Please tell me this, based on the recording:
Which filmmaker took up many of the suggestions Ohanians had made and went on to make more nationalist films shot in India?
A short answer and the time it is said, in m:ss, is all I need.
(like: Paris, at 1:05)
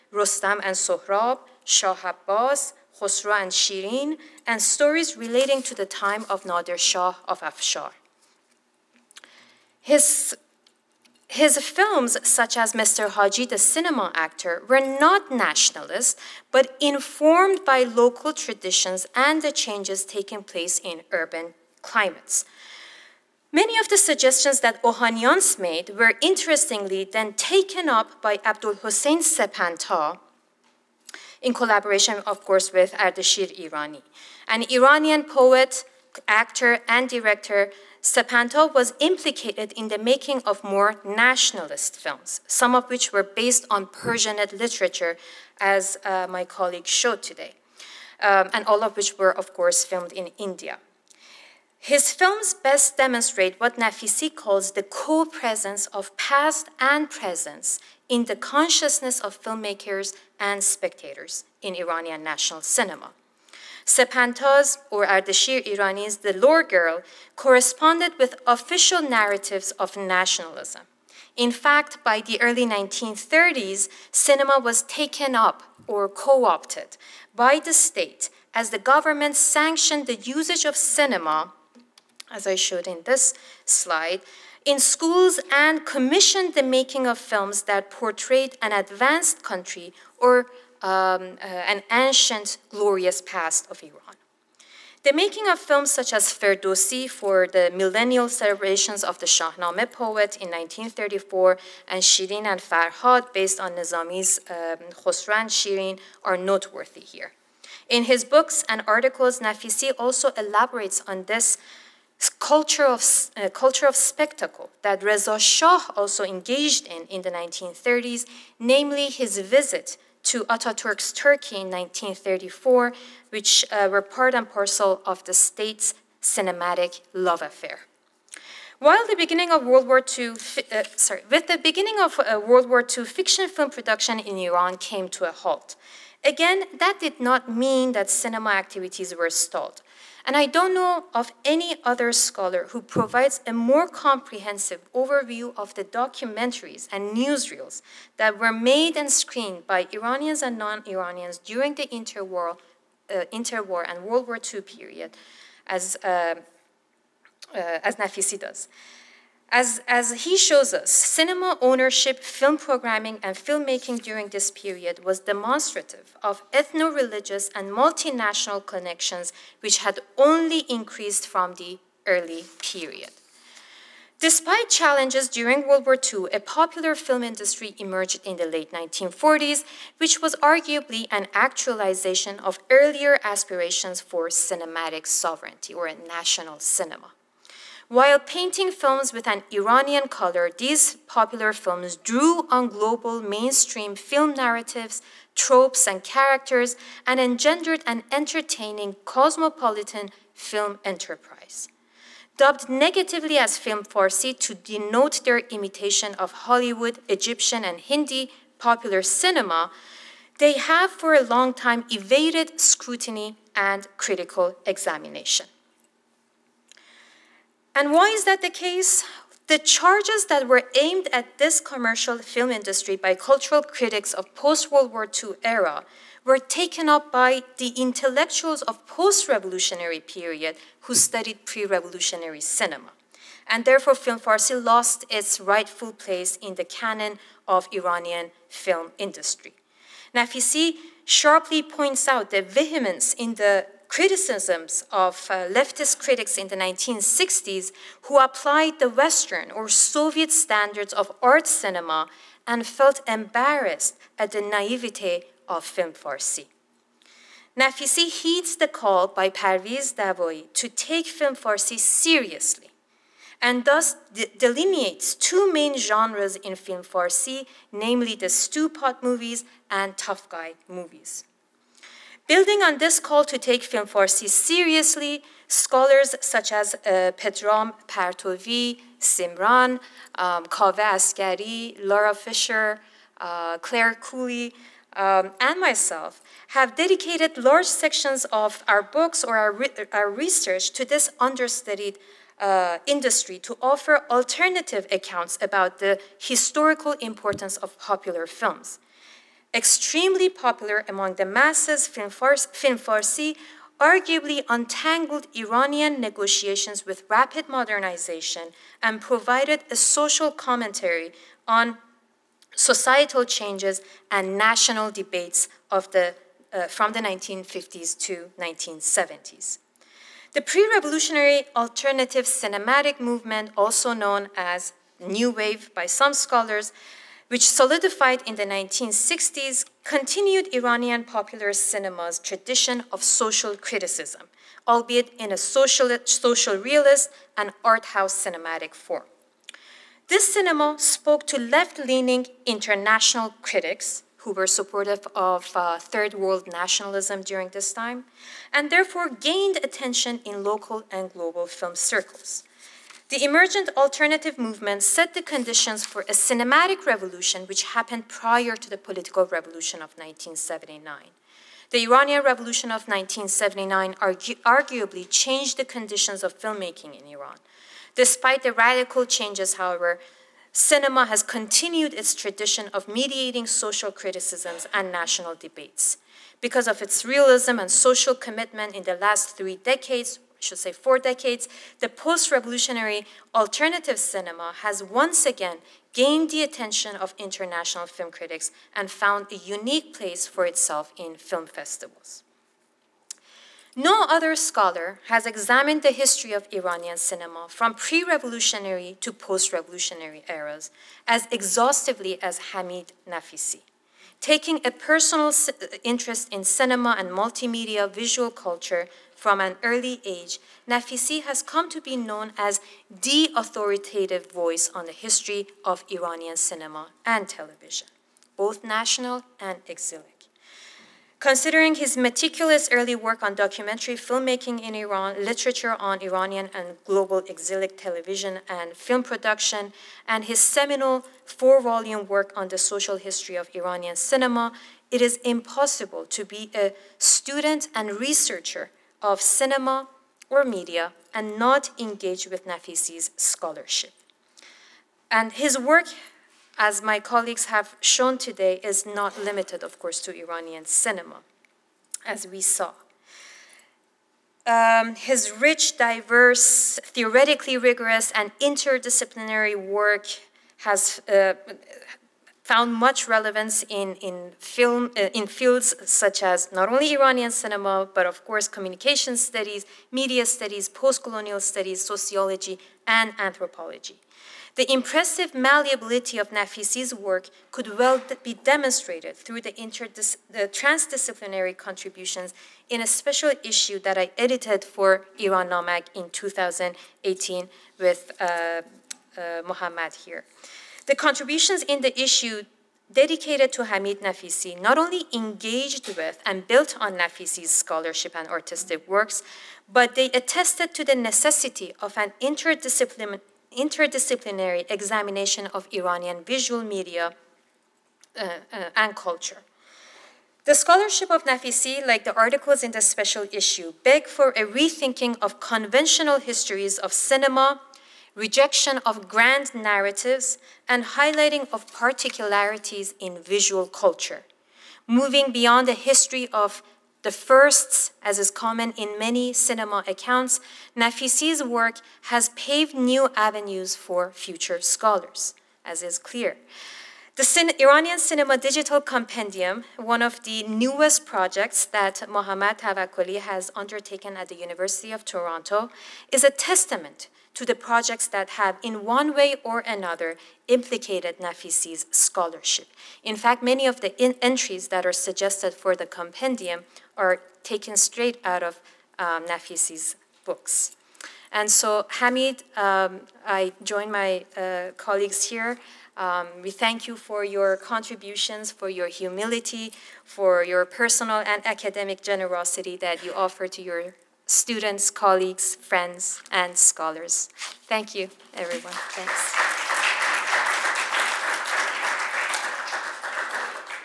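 Abdul Hussein Sepanta, at 0:28.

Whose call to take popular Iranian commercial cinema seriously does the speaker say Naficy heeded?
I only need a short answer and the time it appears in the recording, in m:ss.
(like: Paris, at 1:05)
Parviz Davoyi, at 4:19.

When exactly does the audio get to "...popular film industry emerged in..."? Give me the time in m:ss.
2:56.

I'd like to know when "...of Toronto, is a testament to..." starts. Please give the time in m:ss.
9:04.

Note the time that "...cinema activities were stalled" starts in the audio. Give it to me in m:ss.
2:18.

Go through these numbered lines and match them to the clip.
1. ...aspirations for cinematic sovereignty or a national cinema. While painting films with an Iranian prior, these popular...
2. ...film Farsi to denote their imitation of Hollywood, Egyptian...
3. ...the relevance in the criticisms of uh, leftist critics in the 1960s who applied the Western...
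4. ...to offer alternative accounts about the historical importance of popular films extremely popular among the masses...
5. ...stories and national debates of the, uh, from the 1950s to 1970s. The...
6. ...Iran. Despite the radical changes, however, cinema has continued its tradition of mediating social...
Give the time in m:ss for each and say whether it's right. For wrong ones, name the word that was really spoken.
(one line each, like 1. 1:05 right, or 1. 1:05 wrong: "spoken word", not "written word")
1. 3:03 wrong: "color", not "prior"
2. 3:23 right
3. 4:02 wrong: "vehemence", not "relevance"
4. 4:53 right
5. 5:13 wrong: "changes", not "stories"
6. 6:07 right.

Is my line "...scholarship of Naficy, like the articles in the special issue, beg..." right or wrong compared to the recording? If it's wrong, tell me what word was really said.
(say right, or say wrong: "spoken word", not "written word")
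right.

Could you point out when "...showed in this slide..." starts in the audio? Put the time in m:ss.
1:22.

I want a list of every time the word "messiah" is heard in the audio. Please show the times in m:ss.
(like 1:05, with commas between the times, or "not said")
not said.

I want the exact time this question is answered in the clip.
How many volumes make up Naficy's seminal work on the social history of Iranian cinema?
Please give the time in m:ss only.
7:11.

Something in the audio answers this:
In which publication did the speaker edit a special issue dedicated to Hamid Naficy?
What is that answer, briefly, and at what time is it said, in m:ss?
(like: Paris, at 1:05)
Iran Namag, at 8:05.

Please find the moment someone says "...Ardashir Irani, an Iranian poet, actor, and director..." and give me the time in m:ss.
0:32.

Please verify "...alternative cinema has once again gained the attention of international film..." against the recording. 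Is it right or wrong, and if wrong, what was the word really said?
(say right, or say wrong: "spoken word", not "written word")
right.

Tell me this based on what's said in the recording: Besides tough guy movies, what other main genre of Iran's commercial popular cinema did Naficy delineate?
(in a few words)
Stewpot movies.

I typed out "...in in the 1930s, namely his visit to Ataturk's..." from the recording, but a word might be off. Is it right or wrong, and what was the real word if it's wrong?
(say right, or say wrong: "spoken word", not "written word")
right.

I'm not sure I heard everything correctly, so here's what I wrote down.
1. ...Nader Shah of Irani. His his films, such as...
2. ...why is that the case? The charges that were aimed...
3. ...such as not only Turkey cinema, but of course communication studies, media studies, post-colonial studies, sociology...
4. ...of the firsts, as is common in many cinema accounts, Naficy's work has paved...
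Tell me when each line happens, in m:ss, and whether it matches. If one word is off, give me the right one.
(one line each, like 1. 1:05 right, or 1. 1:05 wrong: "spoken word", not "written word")
1. 0:06 wrong: "Afshar", not "Irani"
2. 3:37 right
3. 7:45 wrong: "Iranian", not "Turkey"
4. 8:46 right.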